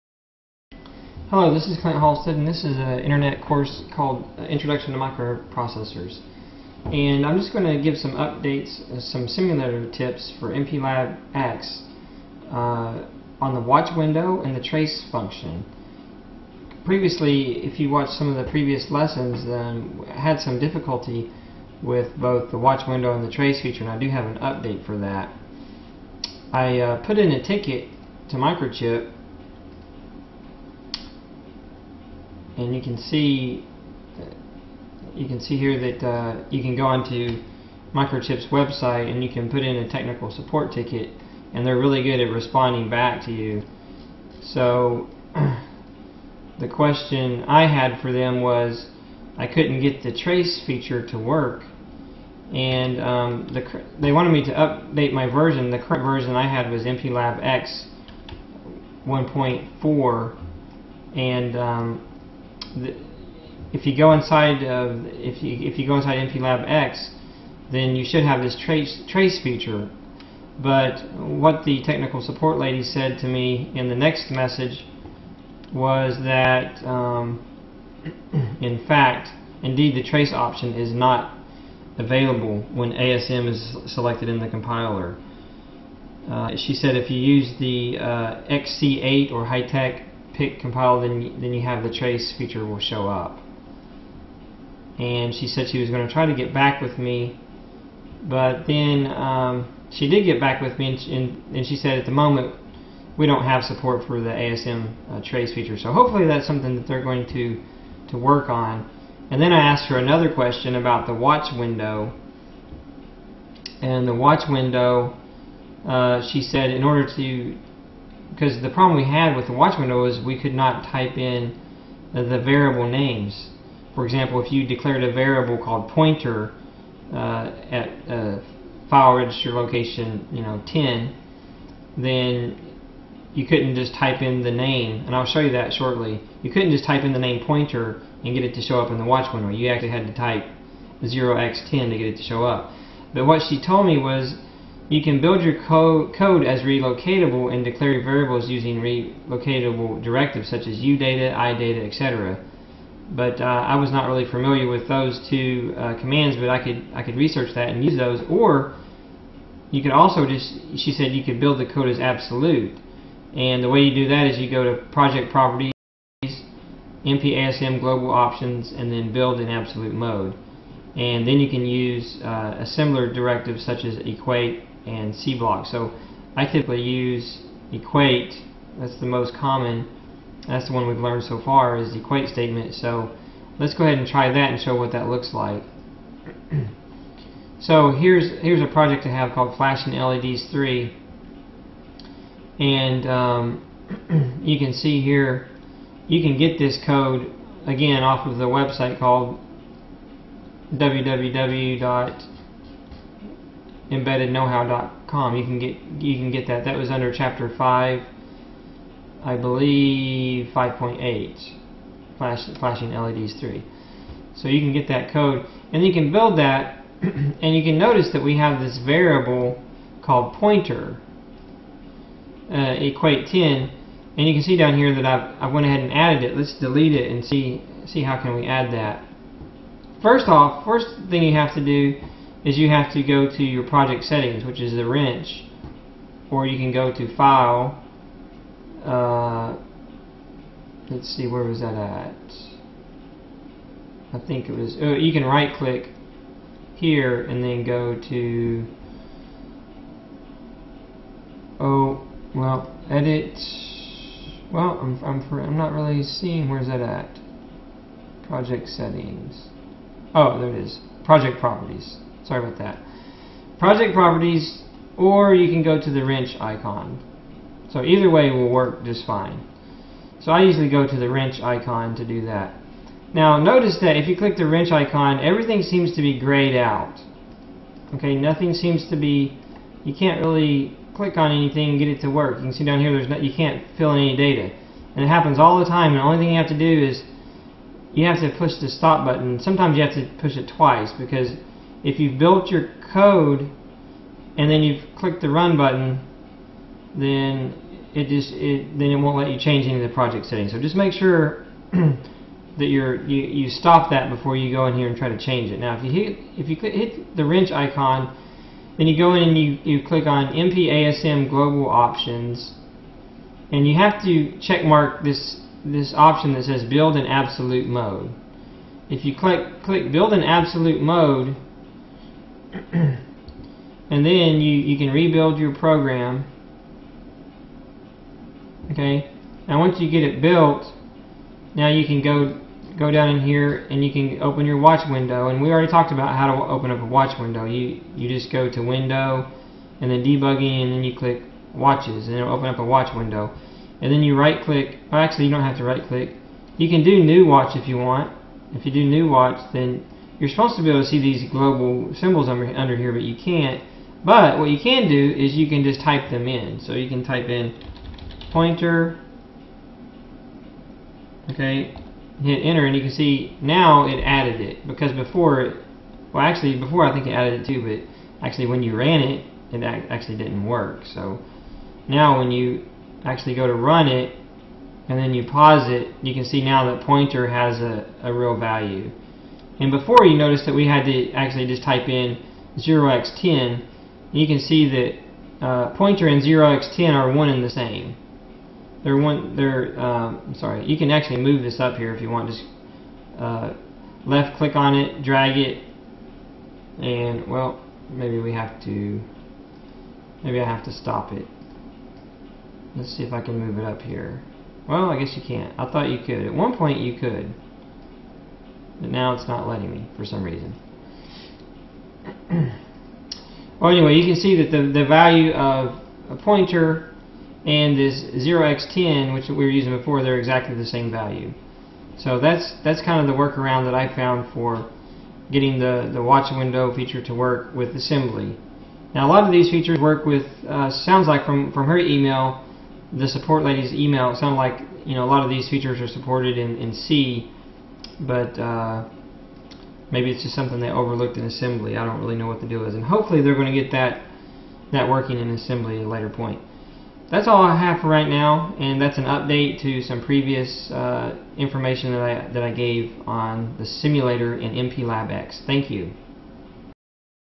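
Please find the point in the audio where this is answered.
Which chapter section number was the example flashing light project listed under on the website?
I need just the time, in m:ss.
3:30.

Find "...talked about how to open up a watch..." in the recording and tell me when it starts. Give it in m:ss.
5:35.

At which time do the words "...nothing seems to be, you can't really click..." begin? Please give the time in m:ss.
4:38.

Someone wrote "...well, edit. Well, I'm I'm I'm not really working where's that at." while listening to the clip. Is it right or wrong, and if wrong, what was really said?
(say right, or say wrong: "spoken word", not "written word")
wrong: "seeing", not "working".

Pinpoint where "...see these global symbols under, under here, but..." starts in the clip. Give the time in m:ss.
5:50.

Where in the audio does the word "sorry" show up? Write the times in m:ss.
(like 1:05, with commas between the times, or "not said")
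4:22, 6:30.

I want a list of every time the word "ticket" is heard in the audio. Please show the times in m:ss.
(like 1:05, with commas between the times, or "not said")
0:27, 0:40.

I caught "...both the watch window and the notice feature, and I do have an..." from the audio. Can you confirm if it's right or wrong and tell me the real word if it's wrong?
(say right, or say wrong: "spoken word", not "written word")
wrong: "trace", not "notice".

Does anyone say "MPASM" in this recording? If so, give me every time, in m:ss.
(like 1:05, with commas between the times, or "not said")
2:47, 5:10.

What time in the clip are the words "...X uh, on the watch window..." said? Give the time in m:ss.
0:11.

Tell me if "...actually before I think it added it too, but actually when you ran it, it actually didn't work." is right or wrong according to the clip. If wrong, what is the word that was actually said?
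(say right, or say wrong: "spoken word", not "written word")
right.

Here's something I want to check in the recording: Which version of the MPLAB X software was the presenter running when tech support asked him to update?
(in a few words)
1.4.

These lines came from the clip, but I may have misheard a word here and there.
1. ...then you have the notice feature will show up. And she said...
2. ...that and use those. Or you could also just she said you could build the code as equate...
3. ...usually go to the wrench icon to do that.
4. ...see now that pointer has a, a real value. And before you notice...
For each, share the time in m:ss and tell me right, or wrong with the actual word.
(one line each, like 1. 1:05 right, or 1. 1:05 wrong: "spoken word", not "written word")
1. 1:31 wrong: "trace", not "notice"
2. 2:37 wrong: "absolute", not "equate"
3. 4:30 right
4. 6:16 right.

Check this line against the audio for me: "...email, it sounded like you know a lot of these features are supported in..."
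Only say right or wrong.
right.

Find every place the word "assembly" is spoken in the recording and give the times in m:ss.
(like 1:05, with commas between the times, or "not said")
7:07, 7:21, 7:25.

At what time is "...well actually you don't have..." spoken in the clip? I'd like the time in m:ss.
5:44.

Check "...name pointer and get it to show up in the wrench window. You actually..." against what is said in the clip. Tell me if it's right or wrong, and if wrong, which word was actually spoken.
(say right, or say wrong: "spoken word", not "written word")
wrong: "watch", not "wrench".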